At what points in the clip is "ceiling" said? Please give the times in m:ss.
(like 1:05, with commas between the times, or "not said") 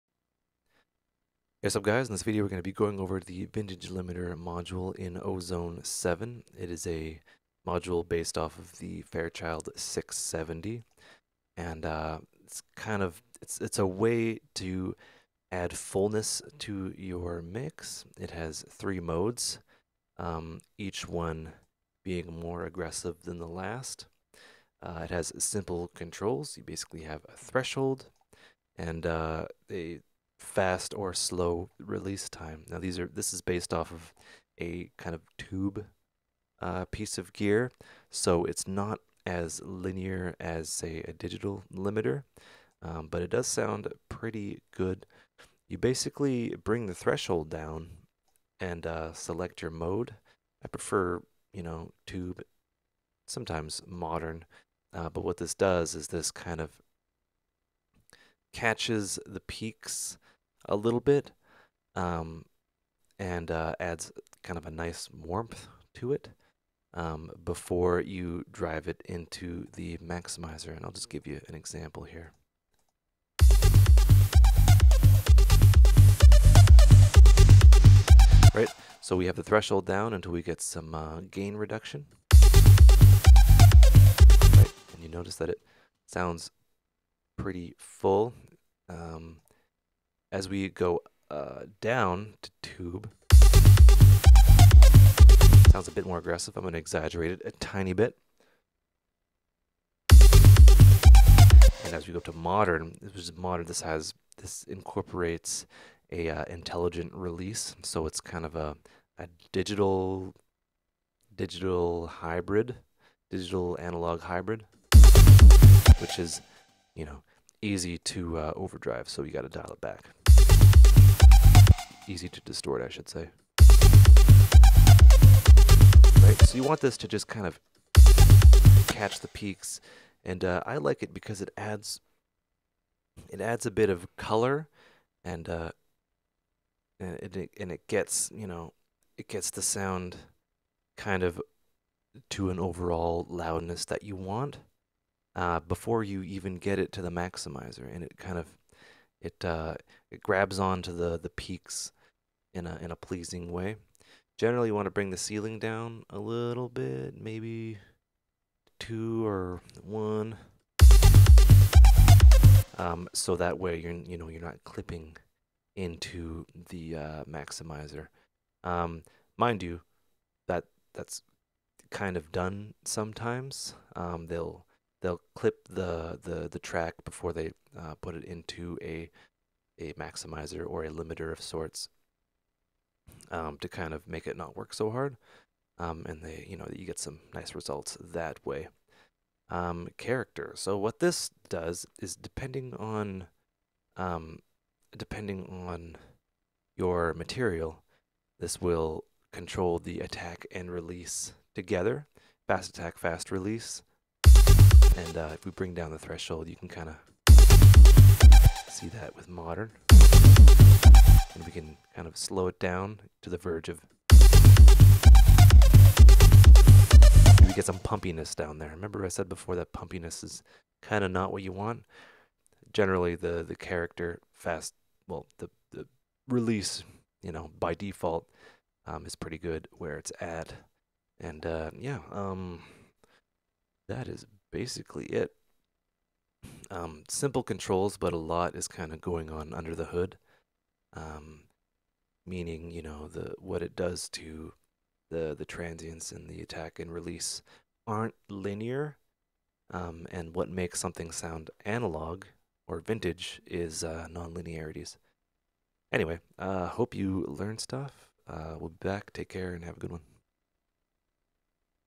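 2:35.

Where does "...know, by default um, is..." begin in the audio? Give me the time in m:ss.
3:47.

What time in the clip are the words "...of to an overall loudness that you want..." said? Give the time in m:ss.
2:21.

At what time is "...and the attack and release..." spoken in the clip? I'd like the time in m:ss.
4:06.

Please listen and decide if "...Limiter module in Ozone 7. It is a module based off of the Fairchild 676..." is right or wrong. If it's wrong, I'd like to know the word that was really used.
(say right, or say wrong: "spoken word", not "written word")
wrong: "670", not "676".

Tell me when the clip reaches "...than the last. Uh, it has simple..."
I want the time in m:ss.
0:23.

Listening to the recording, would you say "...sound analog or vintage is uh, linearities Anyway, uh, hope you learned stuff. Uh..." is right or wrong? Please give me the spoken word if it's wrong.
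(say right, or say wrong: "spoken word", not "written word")
right.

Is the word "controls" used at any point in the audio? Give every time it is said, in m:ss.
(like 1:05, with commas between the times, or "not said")
0:25, 3:19, 3:57.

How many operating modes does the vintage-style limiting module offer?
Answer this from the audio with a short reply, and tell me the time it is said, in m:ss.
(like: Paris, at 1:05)
3, at 0:18.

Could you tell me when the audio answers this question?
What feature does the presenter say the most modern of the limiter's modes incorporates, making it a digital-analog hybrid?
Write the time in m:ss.
1:46.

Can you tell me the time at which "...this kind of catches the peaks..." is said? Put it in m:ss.
0:56.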